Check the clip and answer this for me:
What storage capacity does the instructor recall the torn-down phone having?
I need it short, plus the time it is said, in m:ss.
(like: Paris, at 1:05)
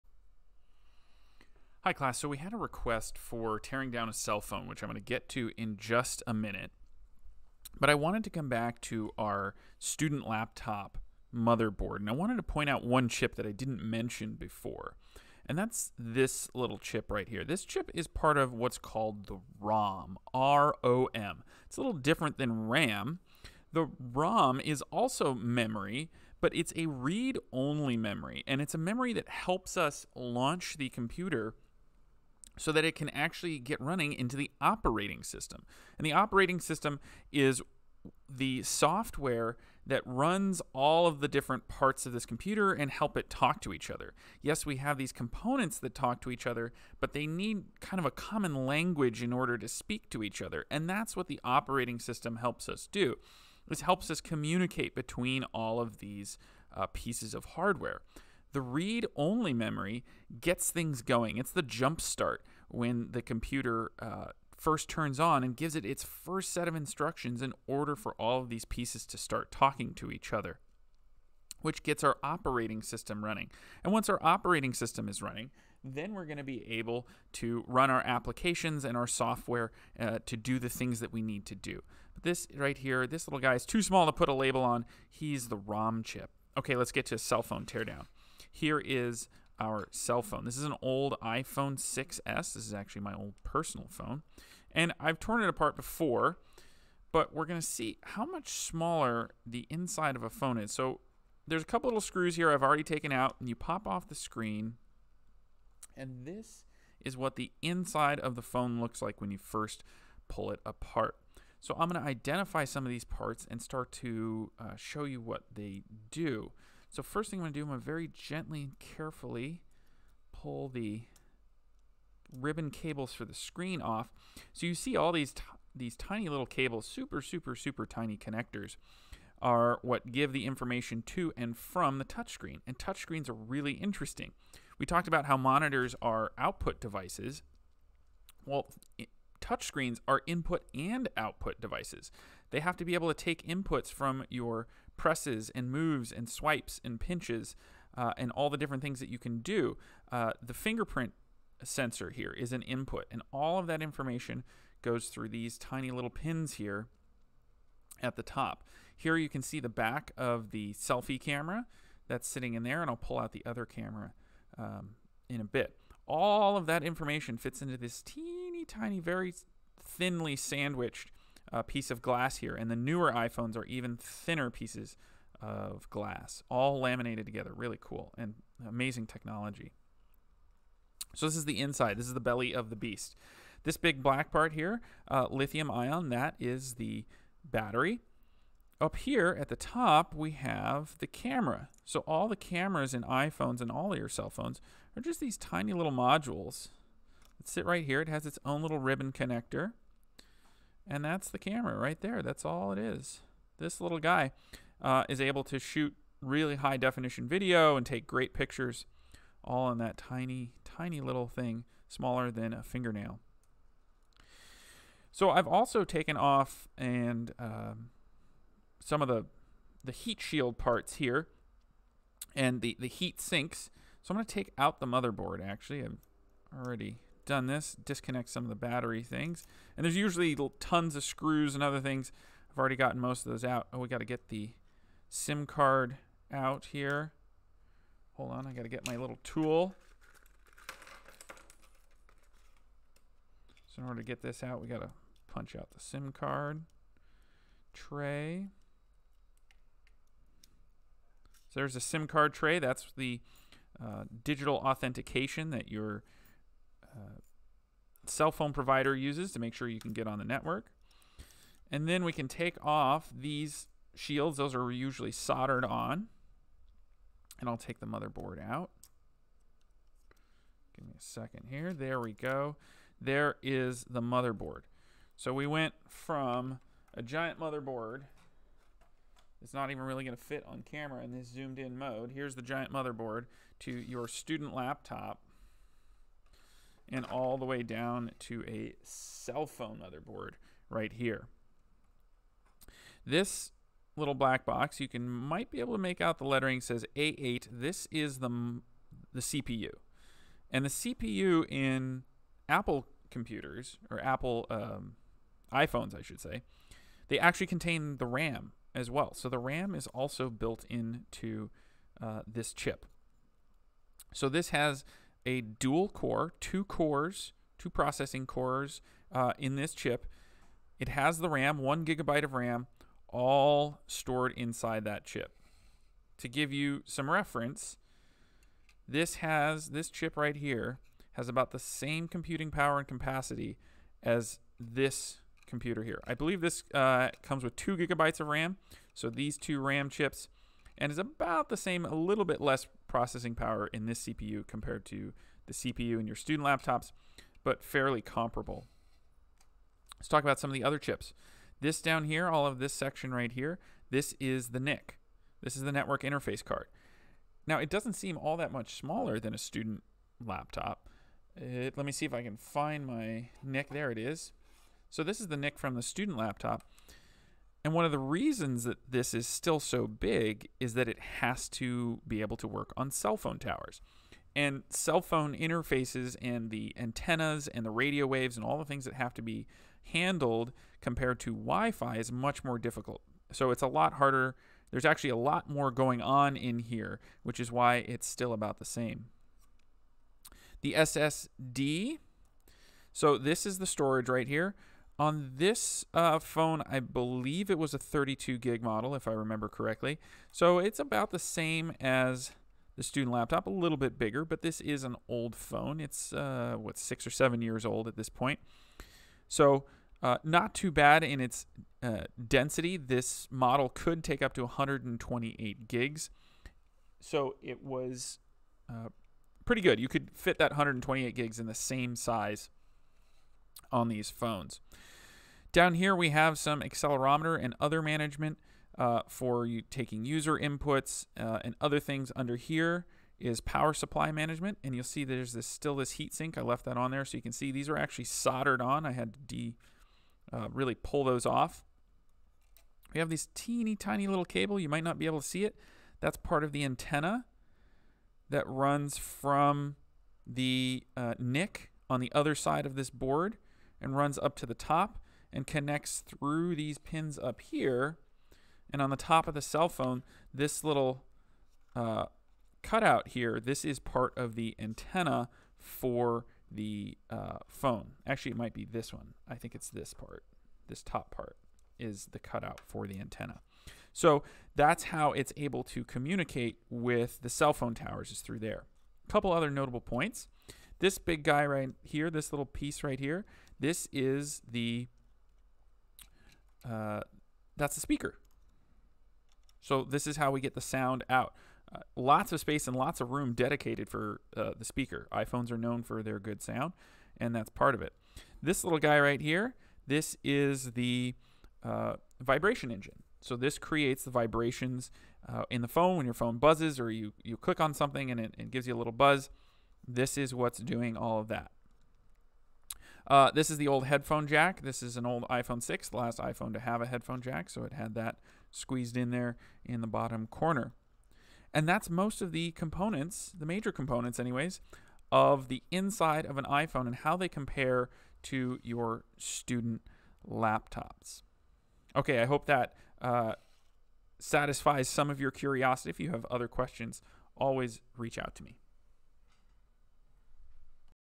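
32 gig, at 6:37.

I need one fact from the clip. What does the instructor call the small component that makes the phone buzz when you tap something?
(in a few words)
Vibration engine.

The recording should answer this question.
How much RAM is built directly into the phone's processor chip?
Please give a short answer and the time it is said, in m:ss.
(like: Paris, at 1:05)
1 gigabyte, at 5:21.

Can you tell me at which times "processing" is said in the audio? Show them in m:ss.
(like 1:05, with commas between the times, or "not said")
5:17, 5:42.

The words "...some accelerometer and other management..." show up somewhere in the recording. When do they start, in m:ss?
7:06.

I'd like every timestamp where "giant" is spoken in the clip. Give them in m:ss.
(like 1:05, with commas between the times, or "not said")
4:37, 4:42.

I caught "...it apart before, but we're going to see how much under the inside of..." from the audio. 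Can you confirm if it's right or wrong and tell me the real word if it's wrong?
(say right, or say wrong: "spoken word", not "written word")
wrong: "smaller", not "under".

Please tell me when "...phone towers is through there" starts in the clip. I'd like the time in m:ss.
7:57.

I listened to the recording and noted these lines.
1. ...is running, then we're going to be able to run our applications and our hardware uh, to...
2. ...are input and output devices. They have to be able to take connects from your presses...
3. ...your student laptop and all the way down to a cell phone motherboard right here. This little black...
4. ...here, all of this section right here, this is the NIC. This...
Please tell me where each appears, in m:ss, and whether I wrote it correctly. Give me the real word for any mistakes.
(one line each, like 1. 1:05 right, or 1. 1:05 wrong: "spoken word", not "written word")
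1. 1:15 wrong: "software", not "hardware"
2. 2:20 wrong: "inputs", not "connects"
3. 4:43 right
4. 5:52 right.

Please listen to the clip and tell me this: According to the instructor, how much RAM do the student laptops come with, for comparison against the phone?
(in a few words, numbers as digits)
2 gigabytes.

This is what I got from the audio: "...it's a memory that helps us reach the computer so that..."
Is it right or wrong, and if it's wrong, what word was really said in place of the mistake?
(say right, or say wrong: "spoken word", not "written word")
wrong: "launch", not "reach".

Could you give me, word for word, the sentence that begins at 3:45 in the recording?
I've already done this, disconnect some of the battery things.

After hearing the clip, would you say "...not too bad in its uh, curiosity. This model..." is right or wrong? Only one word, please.
wrong.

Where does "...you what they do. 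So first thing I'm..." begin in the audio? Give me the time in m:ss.
1:55.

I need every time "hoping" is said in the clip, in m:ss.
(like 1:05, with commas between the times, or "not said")
not said.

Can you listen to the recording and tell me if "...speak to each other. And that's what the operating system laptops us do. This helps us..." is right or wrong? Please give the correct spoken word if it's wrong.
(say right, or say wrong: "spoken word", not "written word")
wrong: "helps", not "laptops".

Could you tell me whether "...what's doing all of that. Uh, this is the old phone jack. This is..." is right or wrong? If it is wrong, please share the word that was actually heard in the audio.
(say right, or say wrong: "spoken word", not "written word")
wrong: "headphone", not "phone".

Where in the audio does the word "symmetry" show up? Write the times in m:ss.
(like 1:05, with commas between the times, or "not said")
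not said.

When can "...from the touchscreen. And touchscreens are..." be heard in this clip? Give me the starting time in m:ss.
2:11.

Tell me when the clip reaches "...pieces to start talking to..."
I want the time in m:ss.
1:08.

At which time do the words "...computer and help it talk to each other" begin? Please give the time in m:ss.
0:42.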